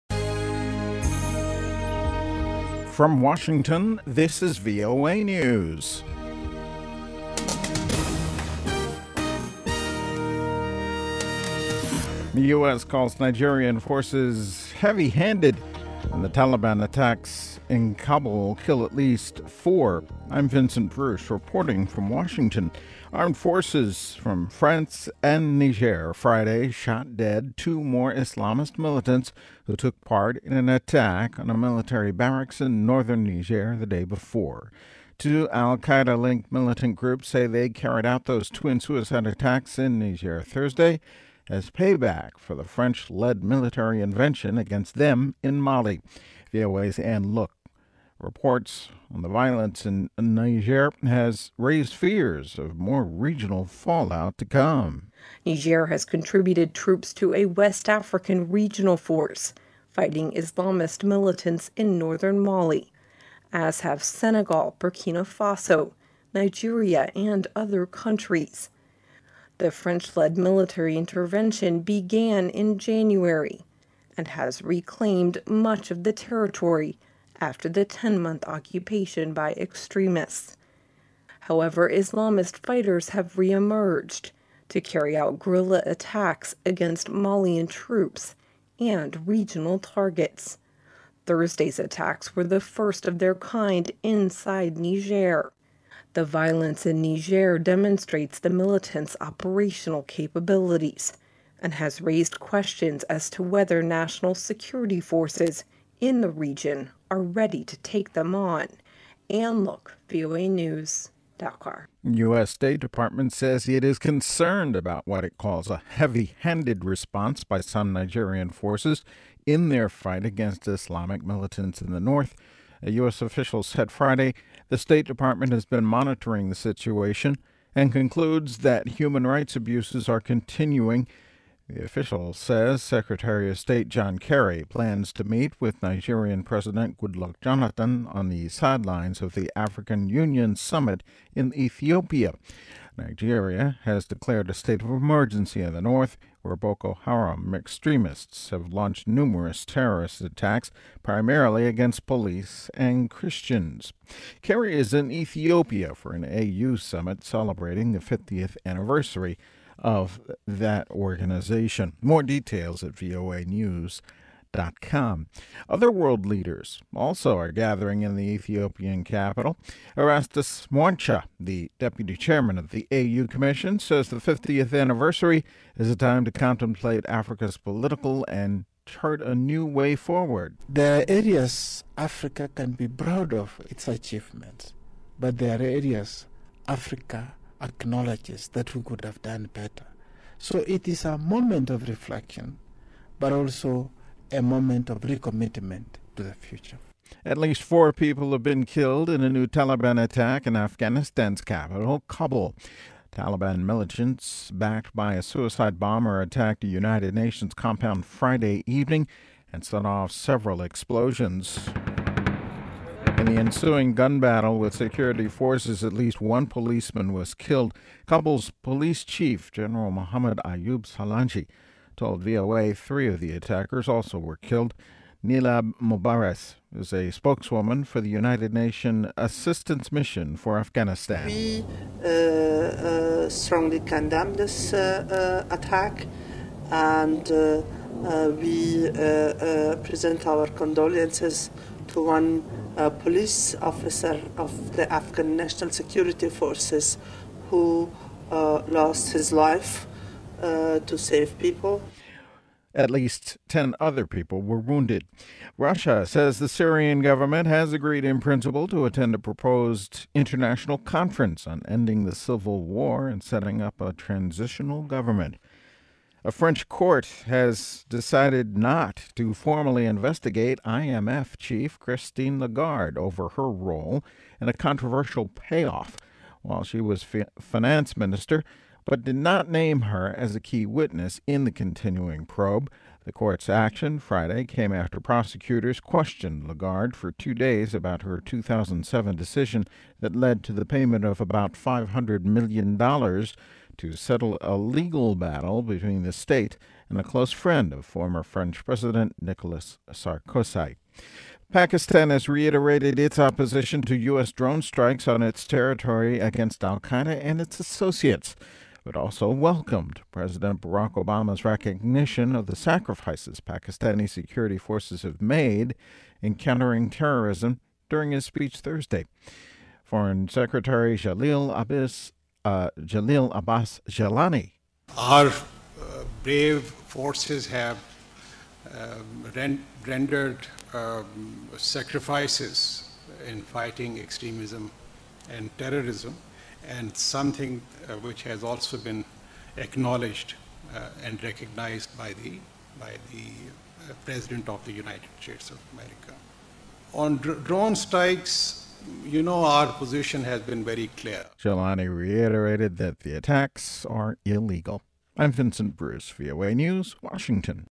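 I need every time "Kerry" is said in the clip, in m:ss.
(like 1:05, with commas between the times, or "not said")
2:14, 2:34.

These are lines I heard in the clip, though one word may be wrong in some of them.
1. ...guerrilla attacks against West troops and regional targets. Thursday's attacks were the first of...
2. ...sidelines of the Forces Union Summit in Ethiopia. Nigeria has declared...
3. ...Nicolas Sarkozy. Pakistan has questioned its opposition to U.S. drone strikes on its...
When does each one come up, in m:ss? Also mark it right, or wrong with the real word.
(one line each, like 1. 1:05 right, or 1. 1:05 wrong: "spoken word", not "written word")
1. 1:25 wrong: "Malian", not "West"
2. 2:18 wrong: "African", not "Forces"
3. 4:59 wrong: "reiterated", not "questioned".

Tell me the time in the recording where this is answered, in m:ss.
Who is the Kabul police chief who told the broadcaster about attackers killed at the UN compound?
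3:39.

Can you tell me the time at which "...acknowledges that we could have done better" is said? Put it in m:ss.
3:07.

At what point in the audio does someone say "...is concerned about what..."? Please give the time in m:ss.
1:53.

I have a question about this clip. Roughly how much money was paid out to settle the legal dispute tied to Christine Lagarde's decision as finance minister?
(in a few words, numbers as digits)
$500 million.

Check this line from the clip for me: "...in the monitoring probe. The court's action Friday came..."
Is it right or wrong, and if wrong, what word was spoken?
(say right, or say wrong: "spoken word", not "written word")
wrong: "continuing", not "monitoring".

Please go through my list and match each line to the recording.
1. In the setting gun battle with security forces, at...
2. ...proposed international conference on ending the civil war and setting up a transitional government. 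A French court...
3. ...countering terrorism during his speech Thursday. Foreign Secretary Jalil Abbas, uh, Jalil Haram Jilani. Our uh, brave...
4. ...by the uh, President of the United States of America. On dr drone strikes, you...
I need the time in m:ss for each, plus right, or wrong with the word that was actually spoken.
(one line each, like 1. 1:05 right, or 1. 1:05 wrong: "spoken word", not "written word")
1. 3:33 wrong: "ensuing", not "setting"
2. 4:19 right
3. 5:16 wrong: "Abbas", not "Haram"
4. 5:42 right.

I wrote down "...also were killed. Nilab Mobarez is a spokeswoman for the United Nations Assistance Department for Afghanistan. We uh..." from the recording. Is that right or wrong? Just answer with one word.
wrong.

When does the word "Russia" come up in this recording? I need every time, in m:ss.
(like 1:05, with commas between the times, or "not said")
4:15.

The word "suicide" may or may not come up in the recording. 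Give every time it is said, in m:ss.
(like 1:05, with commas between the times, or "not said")
0:38, 3:25.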